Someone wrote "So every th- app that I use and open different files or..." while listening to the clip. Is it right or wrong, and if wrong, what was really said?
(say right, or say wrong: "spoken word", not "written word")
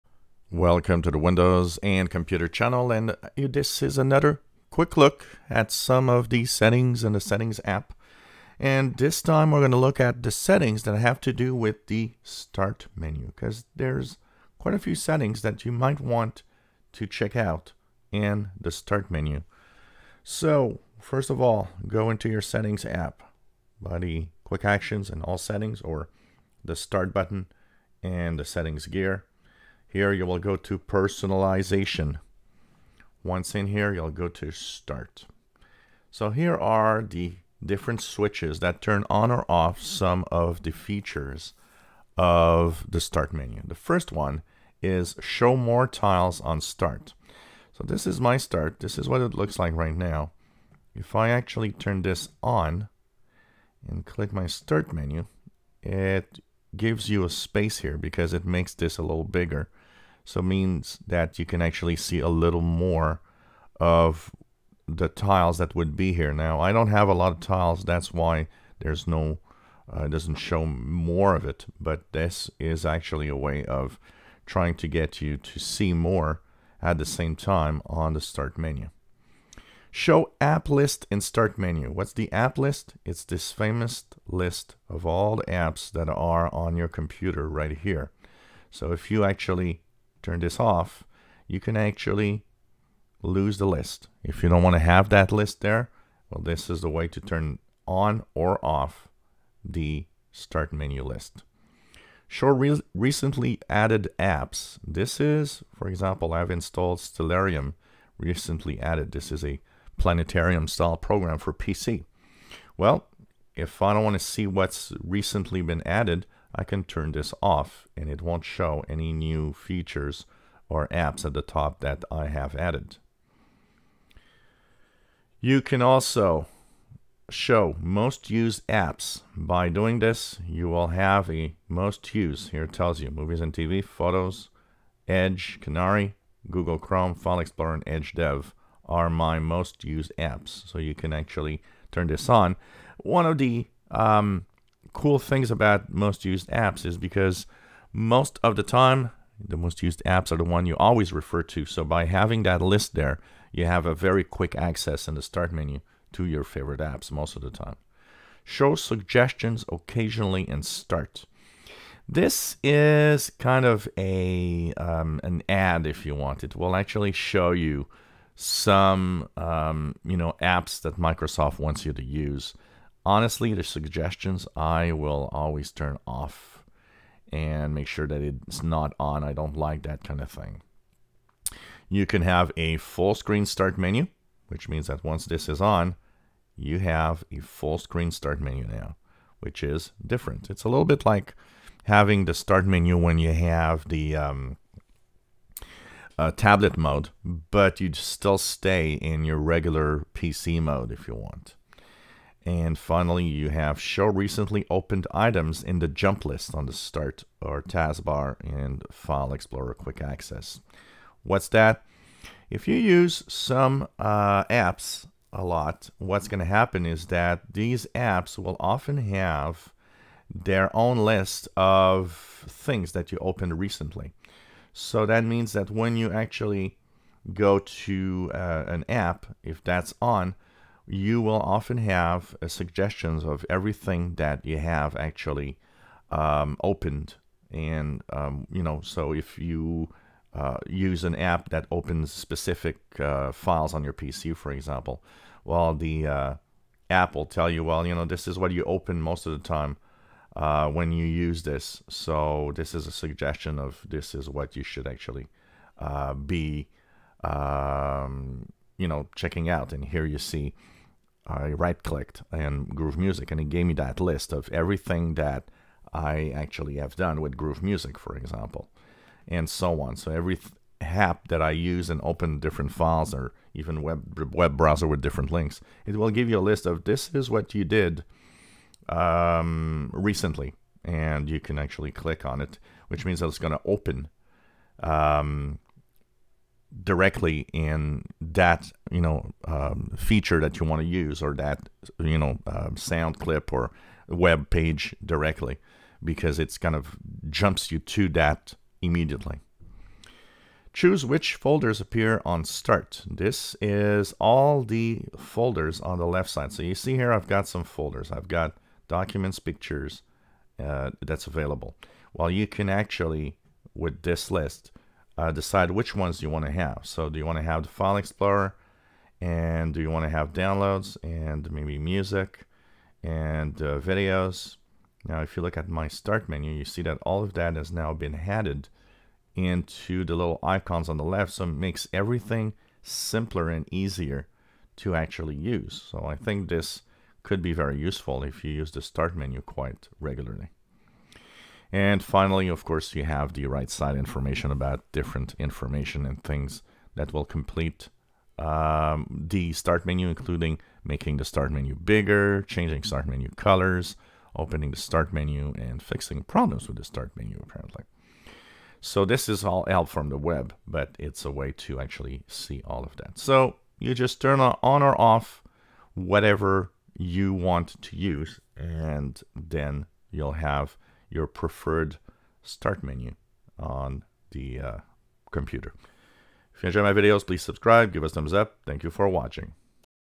right.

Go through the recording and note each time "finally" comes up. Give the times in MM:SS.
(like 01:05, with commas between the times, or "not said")
03:22, 05:42.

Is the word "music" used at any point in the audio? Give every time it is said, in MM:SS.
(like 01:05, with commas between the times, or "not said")
04:22, 04:27, 05:21.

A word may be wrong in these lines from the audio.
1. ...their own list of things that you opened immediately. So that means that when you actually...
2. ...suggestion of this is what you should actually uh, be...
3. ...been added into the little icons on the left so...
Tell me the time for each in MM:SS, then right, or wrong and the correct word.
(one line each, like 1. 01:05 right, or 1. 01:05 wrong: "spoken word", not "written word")
1. 03:40 wrong: "recently", not "immediately"
2. 04:12 right
3. 05:27 right.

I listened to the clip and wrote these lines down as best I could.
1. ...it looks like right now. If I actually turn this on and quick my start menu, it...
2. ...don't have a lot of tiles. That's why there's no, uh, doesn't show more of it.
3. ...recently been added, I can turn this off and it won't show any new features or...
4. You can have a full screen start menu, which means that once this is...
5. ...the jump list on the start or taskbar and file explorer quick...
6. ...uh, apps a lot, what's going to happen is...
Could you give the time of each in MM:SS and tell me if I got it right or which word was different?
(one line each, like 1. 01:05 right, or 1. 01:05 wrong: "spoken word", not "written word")
1. 00:49 wrong: "click", not "quick"
2. 01:06 right
3. 01:55 right
4. 03:01 right
5. 03:25 right
6. 03:33 right.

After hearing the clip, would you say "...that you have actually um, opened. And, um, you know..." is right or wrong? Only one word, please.
right.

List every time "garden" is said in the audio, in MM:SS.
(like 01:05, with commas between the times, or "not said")
not said.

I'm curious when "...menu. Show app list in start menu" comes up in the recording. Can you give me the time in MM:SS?
01:18.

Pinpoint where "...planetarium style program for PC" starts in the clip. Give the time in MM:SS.
01:49.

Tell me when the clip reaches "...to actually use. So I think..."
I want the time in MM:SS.
05:34.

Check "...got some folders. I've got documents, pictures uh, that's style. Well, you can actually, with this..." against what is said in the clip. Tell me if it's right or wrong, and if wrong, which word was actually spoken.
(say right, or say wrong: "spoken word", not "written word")
wrong: "available", not "style".